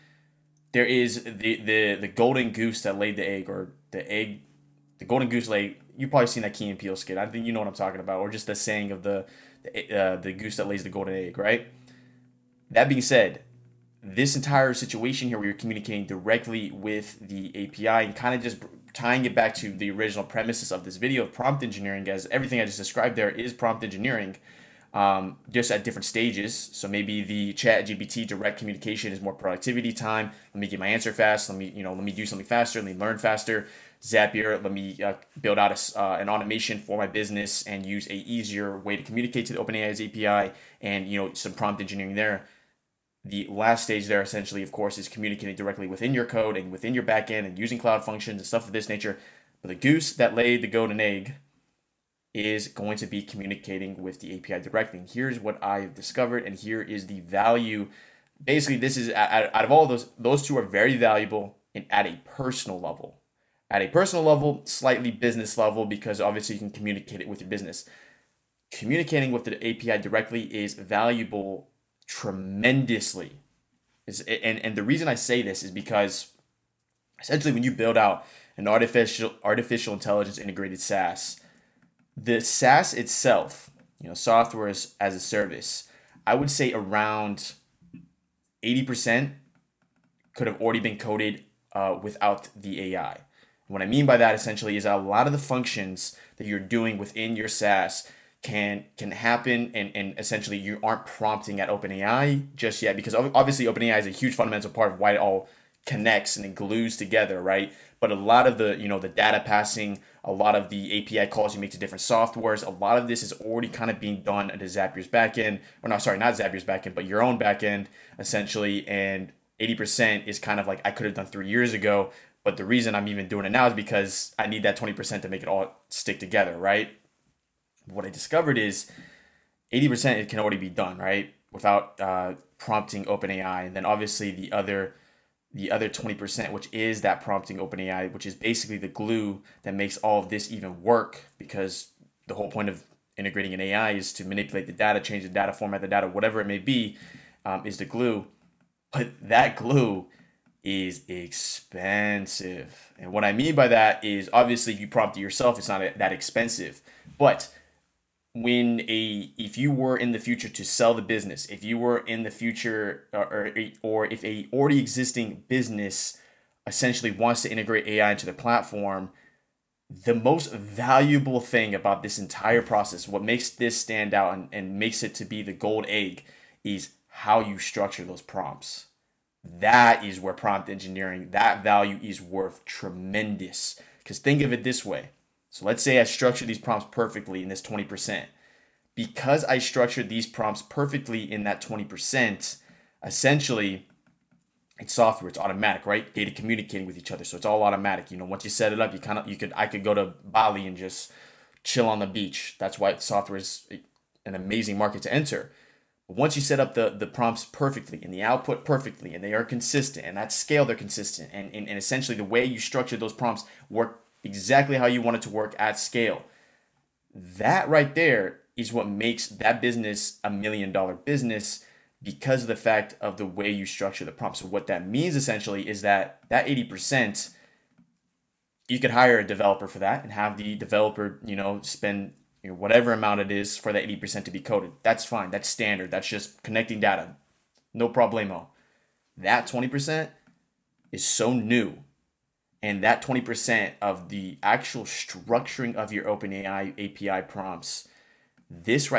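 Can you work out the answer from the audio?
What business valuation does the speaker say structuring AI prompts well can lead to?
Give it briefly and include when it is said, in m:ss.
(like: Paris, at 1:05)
a million dollar, at 3:40.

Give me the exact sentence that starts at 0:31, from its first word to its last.
Let me, you know, let me do something faster.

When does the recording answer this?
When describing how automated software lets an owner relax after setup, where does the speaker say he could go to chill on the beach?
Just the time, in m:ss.
3:20.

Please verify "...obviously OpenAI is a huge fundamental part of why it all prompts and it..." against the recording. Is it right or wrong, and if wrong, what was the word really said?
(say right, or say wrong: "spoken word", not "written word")
wrong: "connects", not "prompts".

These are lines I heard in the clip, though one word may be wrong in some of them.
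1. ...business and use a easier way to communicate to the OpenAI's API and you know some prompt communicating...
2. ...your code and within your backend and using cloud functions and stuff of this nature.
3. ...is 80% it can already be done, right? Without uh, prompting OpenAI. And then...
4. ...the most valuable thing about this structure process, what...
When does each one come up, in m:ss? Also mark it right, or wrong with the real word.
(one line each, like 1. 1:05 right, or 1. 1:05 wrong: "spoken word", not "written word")
1. 0:37 wrong: "engineering", not "communicating"
2. 0:46 right
3. 2:08 right
4. 2:50 wrong: "entire", not "structure".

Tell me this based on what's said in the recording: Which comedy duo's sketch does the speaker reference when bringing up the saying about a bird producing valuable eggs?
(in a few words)
Key and Peele.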